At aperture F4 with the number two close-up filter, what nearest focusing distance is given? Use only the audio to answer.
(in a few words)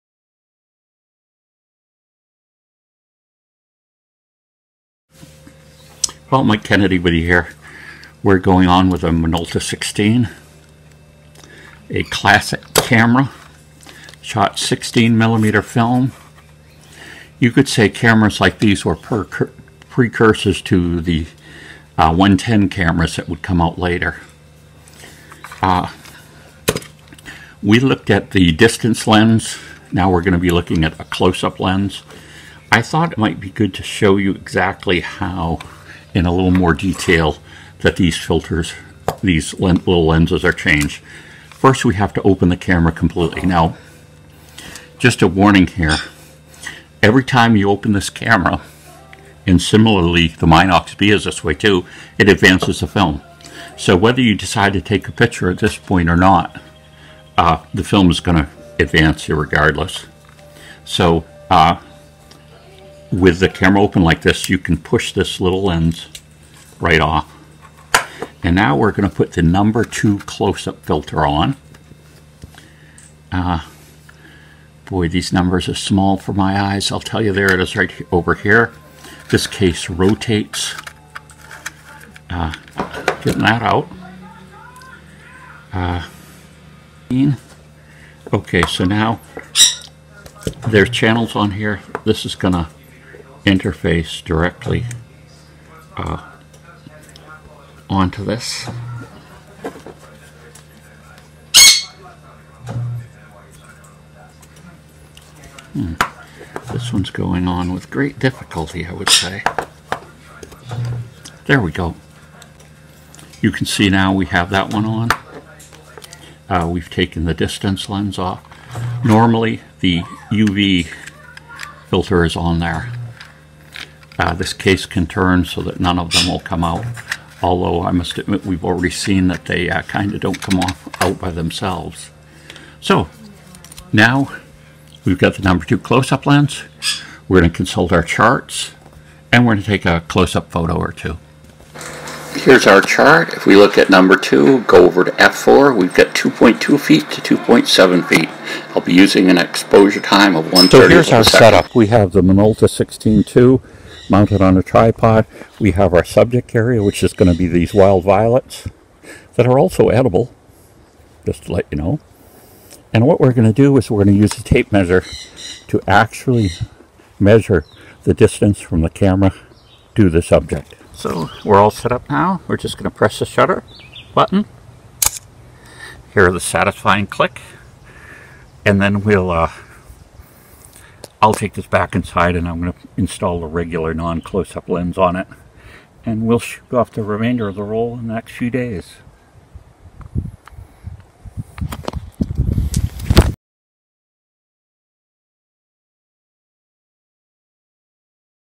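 2.2 feet.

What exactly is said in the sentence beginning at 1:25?
Uh, okay, so now there's channels on here.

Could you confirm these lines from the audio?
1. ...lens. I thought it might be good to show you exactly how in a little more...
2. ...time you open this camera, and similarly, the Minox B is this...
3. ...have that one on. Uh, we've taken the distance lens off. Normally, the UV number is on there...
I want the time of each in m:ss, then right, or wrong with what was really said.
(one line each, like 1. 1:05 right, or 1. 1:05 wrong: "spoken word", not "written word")
1. 0:31 right
2. 0:47 right
3. 1:54 wrong: "filter", not "number".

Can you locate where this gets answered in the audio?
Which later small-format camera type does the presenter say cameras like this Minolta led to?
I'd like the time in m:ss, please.
0:22.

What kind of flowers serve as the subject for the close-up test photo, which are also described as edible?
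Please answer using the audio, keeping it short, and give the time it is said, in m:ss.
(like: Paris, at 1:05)
wild violets, at 2:37.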